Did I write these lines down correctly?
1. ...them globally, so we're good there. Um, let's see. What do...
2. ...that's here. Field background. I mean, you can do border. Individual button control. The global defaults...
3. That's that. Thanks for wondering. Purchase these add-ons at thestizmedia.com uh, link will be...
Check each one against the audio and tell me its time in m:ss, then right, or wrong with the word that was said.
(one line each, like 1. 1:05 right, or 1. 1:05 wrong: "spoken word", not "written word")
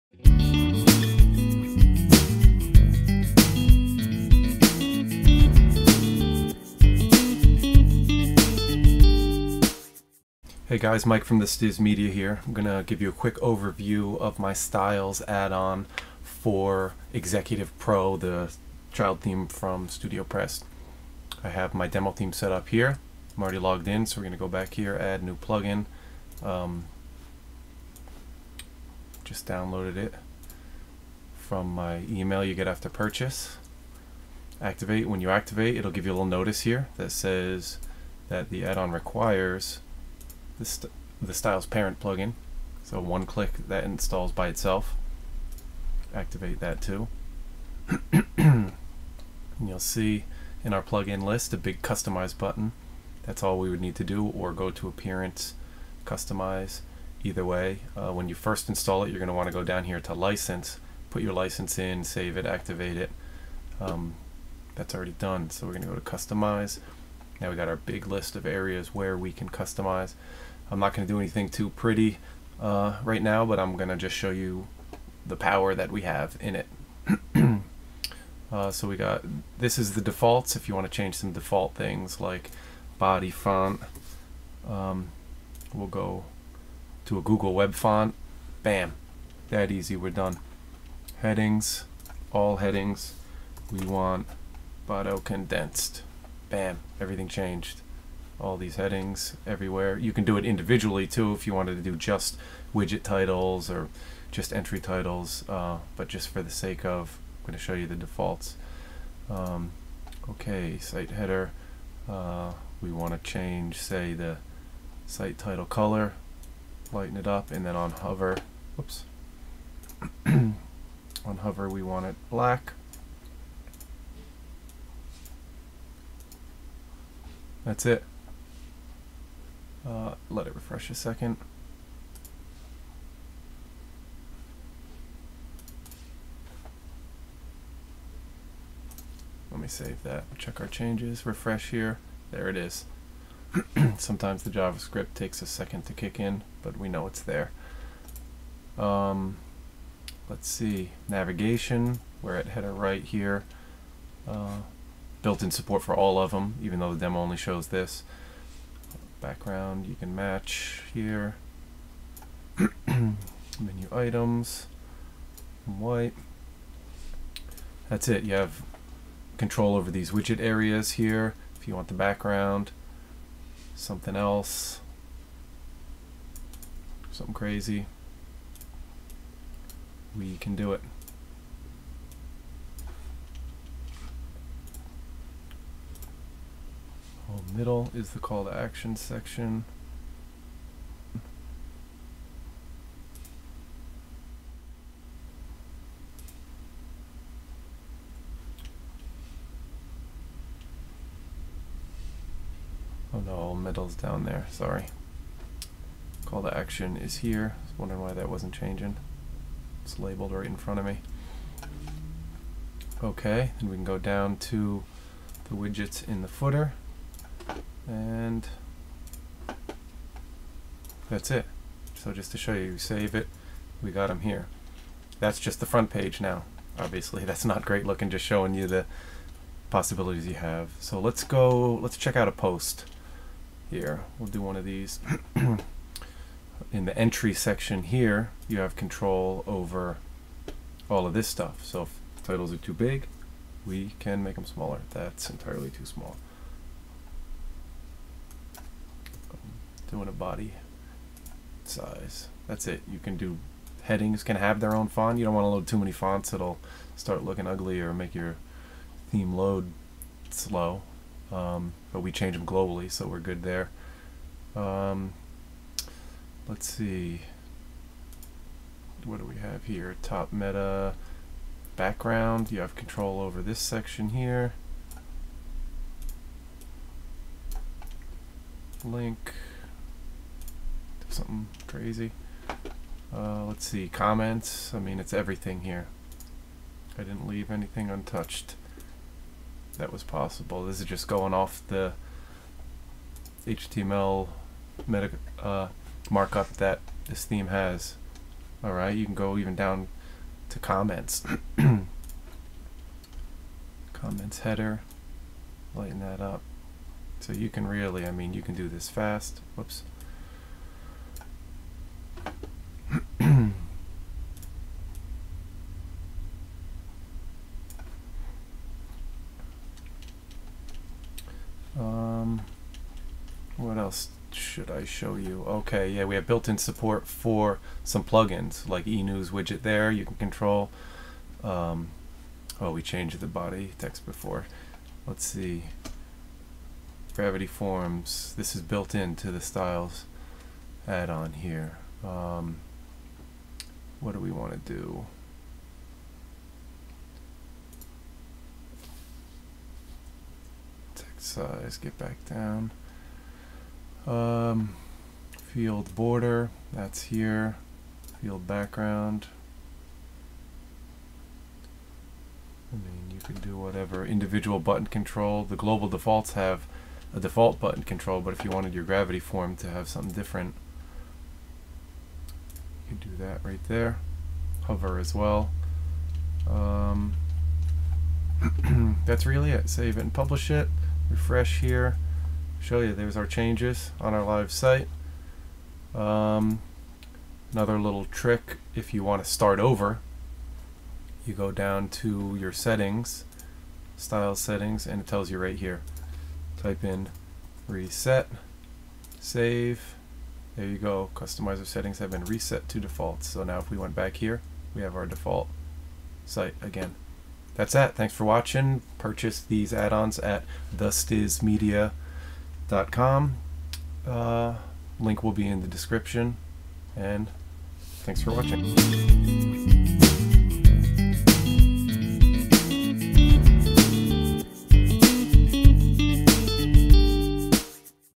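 1. 4:22 right
2. 5:56 wrong: "whatever", not "border"
3. 6:47 wrong: "watching", not "wondering".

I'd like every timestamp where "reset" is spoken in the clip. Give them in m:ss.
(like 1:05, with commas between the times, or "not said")
6:37, 6:42.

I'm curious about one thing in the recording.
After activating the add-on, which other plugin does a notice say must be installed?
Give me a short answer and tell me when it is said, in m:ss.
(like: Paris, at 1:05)
Styles Parent, at 0:41.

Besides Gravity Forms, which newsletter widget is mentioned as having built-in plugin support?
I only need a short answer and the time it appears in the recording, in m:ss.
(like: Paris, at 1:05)
eNews widget, at 5:28.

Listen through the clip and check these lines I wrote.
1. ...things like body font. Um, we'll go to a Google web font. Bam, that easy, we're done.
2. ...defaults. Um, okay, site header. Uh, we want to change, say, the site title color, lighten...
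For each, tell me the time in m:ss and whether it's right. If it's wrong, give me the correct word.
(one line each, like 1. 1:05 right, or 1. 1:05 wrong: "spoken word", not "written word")
1. 1:21 right
2. 1:47 right.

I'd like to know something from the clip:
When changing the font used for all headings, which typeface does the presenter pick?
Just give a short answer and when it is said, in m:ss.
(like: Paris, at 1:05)
Bodo condensed, at 1:34.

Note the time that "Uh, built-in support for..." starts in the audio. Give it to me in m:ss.
2:34.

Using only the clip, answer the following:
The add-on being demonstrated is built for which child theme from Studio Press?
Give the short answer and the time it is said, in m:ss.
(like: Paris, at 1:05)
Executive Pro, at 0:17.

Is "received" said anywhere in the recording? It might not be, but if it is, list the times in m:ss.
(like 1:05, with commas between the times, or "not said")
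not said.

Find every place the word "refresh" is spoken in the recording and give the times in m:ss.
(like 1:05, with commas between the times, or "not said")
2:10, 2:21, 6:21.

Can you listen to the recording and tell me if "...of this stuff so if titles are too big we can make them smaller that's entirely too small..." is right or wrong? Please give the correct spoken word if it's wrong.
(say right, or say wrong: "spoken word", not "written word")
right.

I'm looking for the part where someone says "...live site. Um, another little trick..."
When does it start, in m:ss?
6:24.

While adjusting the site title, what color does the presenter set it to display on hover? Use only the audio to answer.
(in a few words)
Black.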